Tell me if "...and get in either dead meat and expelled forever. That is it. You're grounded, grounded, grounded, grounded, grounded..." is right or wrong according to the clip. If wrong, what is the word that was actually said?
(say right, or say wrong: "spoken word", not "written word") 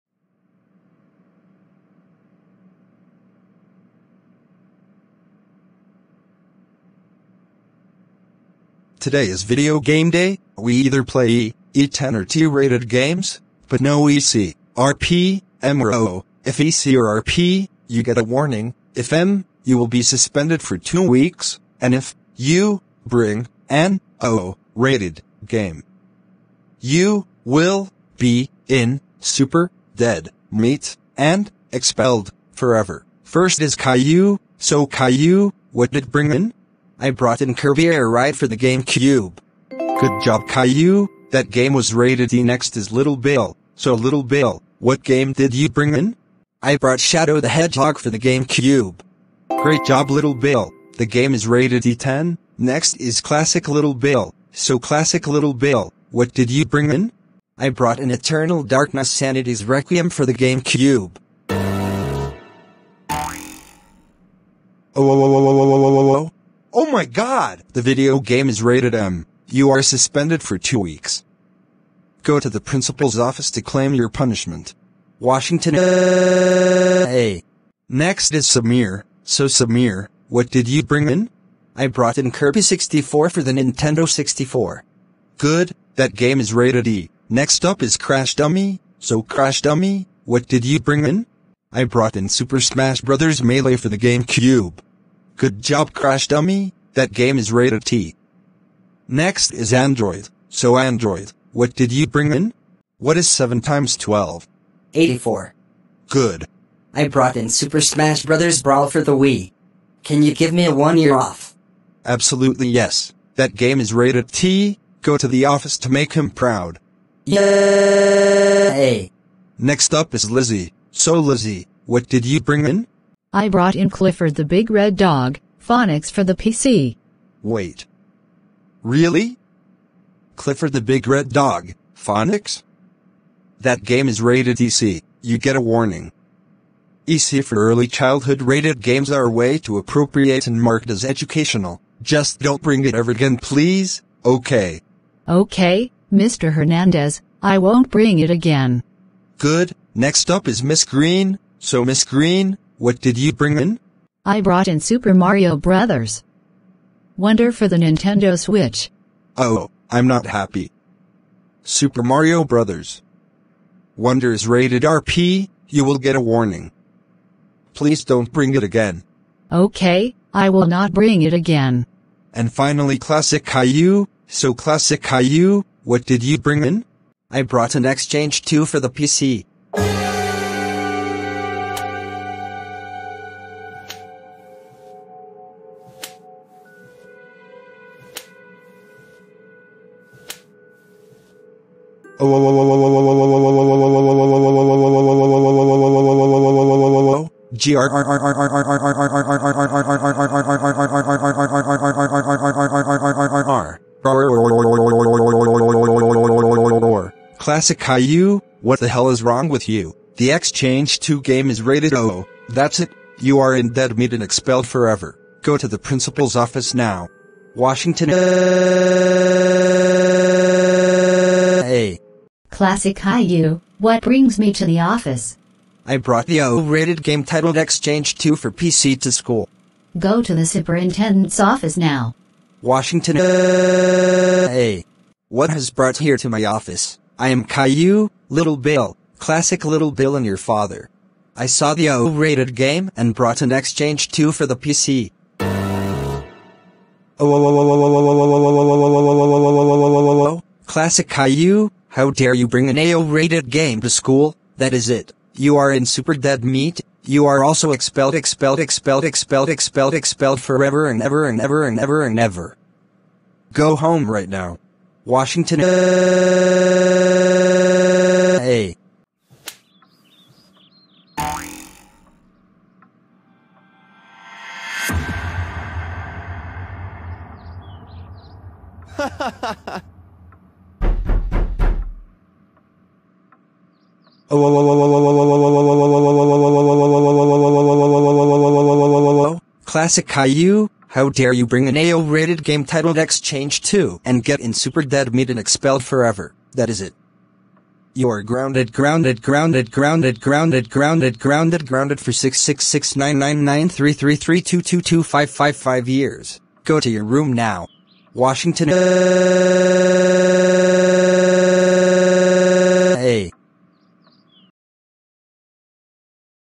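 wrong: "super", not "either".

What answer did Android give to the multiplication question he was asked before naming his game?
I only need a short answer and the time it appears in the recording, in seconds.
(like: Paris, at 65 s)
84, at 104 s.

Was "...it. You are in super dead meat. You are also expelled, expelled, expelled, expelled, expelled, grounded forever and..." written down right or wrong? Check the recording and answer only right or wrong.
wrong.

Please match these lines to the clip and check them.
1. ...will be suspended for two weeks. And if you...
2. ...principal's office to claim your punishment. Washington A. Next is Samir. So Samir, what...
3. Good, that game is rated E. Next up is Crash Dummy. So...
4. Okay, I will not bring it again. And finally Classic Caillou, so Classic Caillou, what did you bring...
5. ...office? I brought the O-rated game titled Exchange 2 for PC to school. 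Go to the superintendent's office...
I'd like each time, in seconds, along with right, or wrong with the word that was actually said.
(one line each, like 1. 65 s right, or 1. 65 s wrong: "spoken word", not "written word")
1. 19 s right
2. 72 s right
3. 85 s right
4. 169 s right
5. 224 s right.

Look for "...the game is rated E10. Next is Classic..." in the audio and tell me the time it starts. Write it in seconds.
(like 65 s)
50 s.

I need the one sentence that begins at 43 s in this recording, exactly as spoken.
So Little Bill, what game did you bring in?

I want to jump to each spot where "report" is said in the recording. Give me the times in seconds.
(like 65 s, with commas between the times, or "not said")
not said.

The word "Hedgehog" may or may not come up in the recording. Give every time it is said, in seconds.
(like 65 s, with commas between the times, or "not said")
47 s.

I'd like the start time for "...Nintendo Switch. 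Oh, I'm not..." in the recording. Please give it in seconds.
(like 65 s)
157 s.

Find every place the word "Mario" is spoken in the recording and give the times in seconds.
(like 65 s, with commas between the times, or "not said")
155 s, 162 s.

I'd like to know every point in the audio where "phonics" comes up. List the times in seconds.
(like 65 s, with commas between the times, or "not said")
125 s, 131 s.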